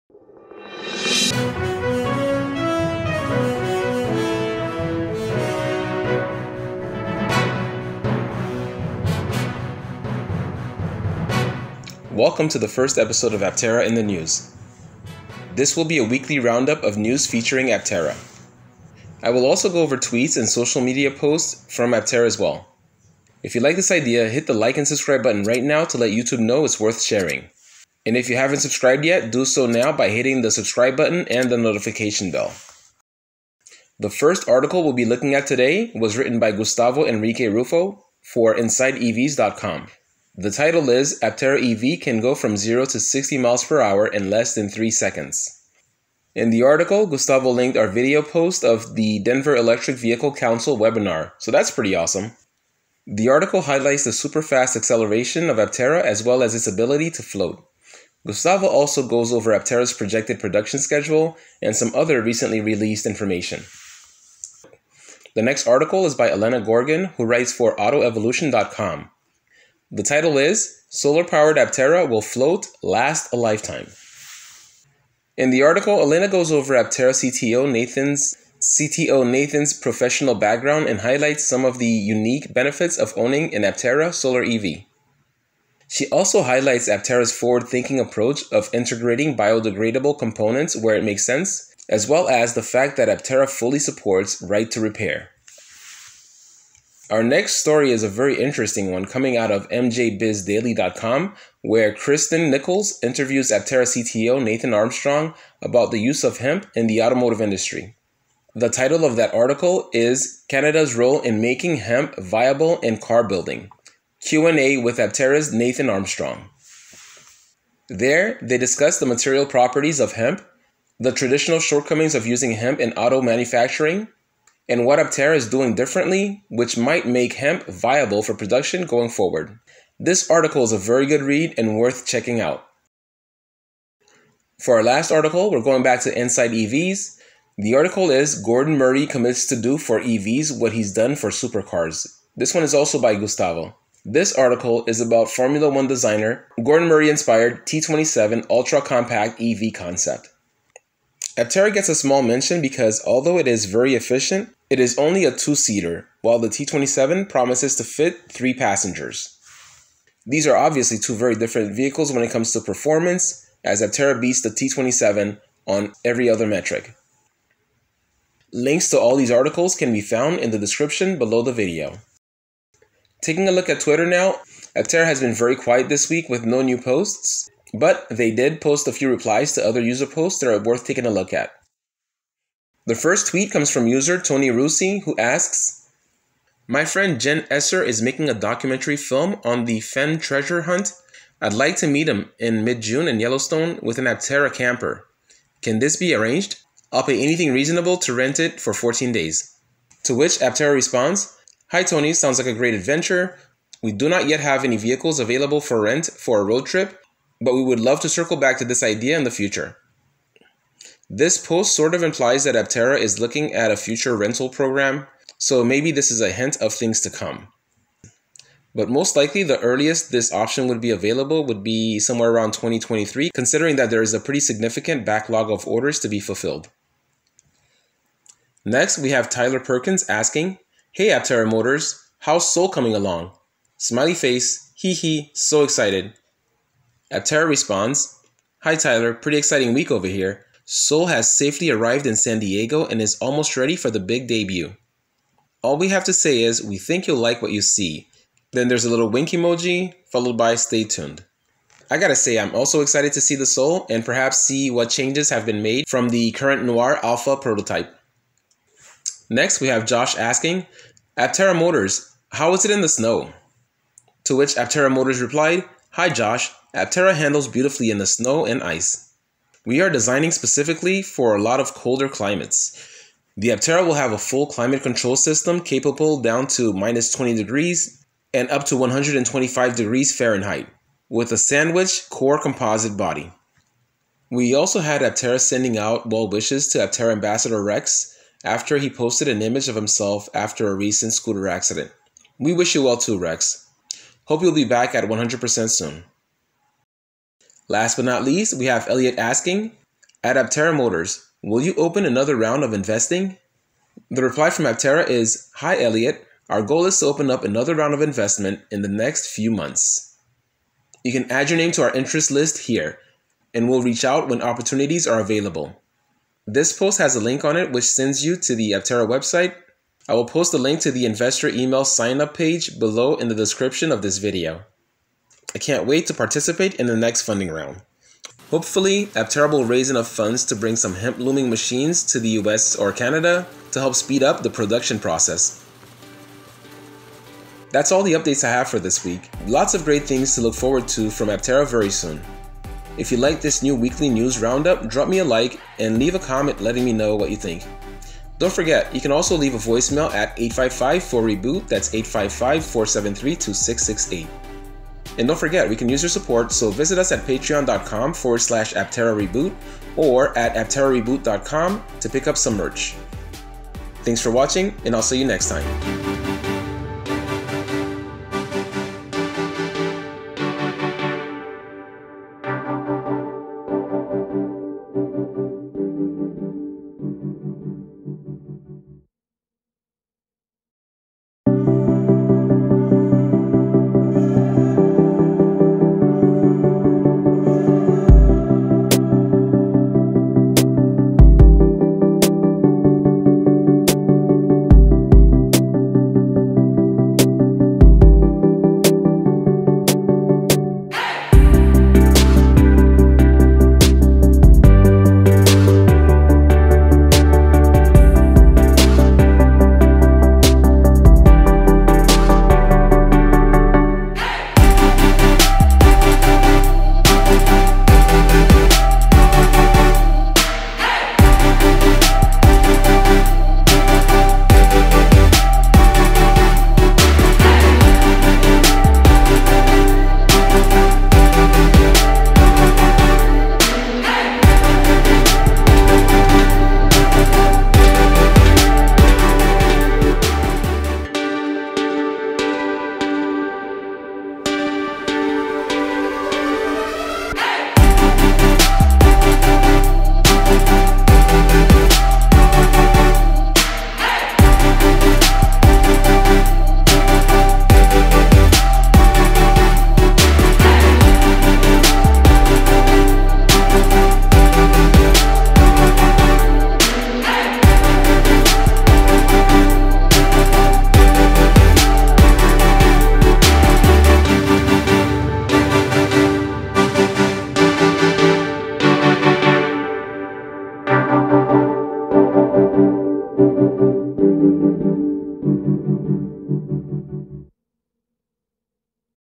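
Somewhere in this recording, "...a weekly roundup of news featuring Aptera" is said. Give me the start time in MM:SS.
00:15.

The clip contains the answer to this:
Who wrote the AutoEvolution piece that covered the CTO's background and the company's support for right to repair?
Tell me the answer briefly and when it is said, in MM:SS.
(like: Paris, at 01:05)
Elena Gorgan, at 01:06.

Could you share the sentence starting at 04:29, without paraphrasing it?
We are designing specifically for a lot of colder climates.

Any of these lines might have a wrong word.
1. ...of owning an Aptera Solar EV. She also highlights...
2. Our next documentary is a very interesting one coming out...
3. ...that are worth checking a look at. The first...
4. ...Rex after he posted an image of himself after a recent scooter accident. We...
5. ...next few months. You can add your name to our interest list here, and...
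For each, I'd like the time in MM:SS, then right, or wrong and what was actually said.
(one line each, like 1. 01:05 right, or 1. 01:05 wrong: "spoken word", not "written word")
1. 01:22 right
2. 01:37 wrong: "story", not "documentary"
3. 03:00 wrong: "taking", not "checking"
4. 04:47 right
5. 05:08 right.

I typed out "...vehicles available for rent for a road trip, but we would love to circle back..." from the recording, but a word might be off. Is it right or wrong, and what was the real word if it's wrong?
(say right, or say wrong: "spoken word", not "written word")
right.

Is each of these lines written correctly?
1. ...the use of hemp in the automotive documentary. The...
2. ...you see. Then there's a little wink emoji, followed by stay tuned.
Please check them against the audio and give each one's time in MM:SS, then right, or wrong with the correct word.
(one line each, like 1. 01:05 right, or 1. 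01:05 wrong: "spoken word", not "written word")
1. 01:45 wrong: "industry", not "documentary"
2. 04:07 right.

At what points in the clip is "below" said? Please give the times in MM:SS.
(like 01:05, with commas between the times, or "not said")
02:51, 05:22.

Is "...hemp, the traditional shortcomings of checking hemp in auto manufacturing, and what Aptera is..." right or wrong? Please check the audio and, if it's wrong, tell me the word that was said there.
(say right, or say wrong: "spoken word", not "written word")
wrong: "using", not "checking".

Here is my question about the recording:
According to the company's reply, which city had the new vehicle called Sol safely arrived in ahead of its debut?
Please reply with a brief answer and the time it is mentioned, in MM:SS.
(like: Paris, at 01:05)
San Diego, at 04:02.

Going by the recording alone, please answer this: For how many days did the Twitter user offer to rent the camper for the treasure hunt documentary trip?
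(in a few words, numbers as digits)
14.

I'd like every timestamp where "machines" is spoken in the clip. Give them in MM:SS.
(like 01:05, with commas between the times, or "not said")
05:31.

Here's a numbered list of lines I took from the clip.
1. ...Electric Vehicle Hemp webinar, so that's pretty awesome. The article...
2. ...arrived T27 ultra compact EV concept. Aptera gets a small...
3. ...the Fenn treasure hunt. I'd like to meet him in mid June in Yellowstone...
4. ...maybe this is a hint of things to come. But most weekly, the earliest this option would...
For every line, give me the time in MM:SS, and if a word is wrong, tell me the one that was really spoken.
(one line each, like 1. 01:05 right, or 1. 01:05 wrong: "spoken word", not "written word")
1. 00:49 wrong: "Council", not "Hemp"
2. 02:27 wrong: "inspired", not "arrived"
3. 03:09 right
4. 03:35 wrong: "likely", not "weekly".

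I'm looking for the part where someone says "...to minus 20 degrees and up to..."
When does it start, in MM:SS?
04:36.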